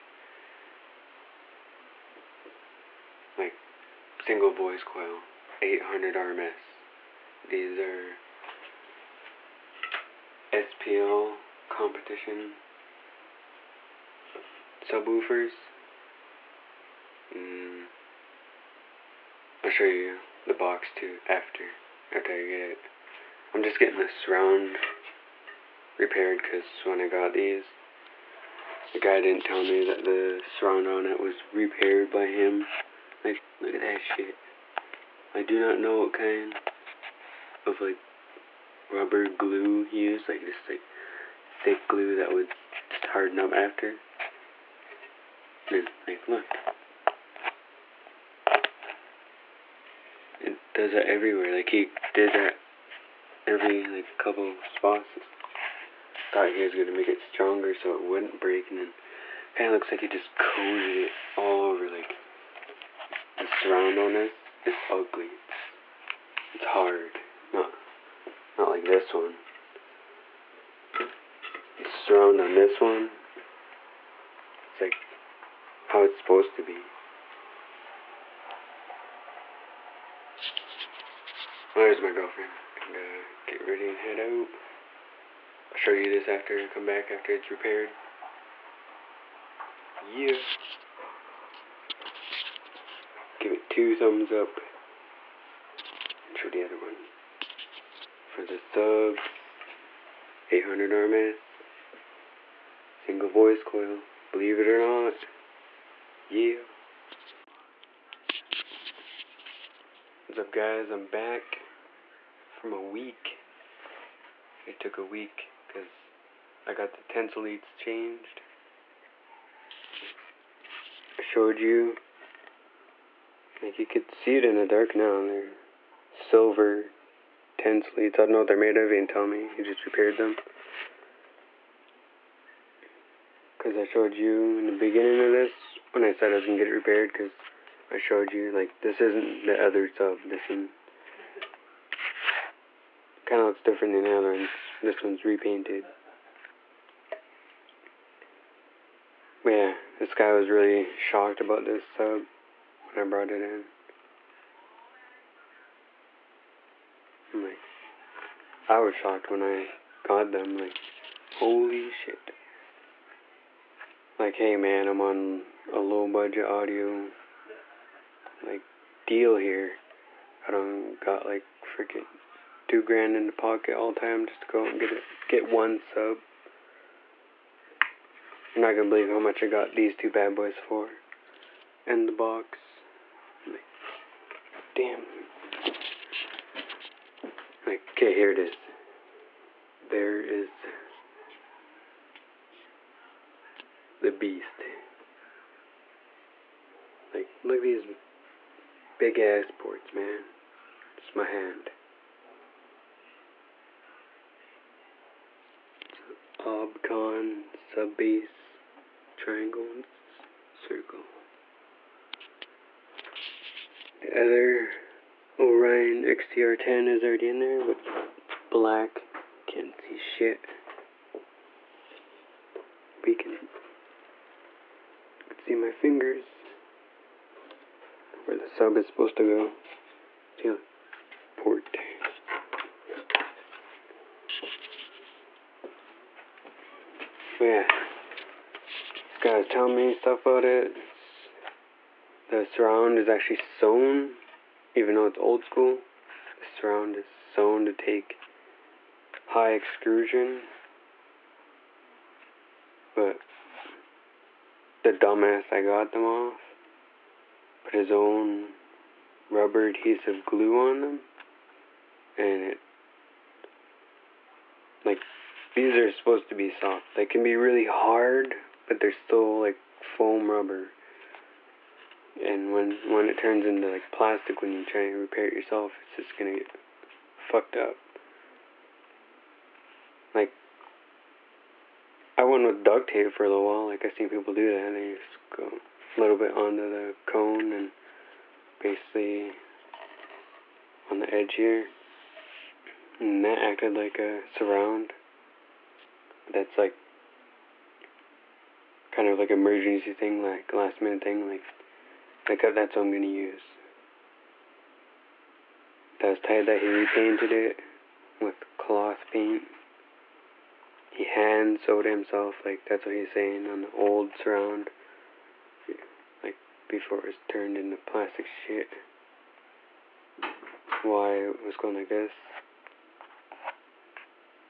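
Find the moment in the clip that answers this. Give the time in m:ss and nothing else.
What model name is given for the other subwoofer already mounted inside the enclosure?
3:35.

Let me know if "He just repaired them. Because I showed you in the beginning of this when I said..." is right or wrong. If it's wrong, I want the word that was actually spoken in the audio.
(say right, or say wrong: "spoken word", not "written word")
right.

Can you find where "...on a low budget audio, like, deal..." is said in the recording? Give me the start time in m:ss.
2:45.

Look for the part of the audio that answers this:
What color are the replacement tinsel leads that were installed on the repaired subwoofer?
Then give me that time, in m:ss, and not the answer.
2:06.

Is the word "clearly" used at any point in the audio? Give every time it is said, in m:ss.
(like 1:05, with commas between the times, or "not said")
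not said.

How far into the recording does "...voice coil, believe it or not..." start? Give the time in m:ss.
1:43.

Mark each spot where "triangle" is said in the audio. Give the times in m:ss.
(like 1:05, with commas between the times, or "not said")
3:29.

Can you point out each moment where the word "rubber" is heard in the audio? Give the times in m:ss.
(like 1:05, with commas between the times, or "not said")
0:38, 4:19, 4:30.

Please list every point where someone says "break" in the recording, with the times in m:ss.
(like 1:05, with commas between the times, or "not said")
0:58.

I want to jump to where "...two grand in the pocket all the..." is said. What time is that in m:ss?
2:52.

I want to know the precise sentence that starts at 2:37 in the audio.
i like, I was shocked when I got them.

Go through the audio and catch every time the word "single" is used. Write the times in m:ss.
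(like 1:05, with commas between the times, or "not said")
0:04, 1:43.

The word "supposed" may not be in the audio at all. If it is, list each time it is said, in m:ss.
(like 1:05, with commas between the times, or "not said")
1:16, 3:48, 4:25.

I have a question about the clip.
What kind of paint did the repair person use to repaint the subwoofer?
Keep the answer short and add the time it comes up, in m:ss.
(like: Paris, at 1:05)
cloth paint, at 5:08.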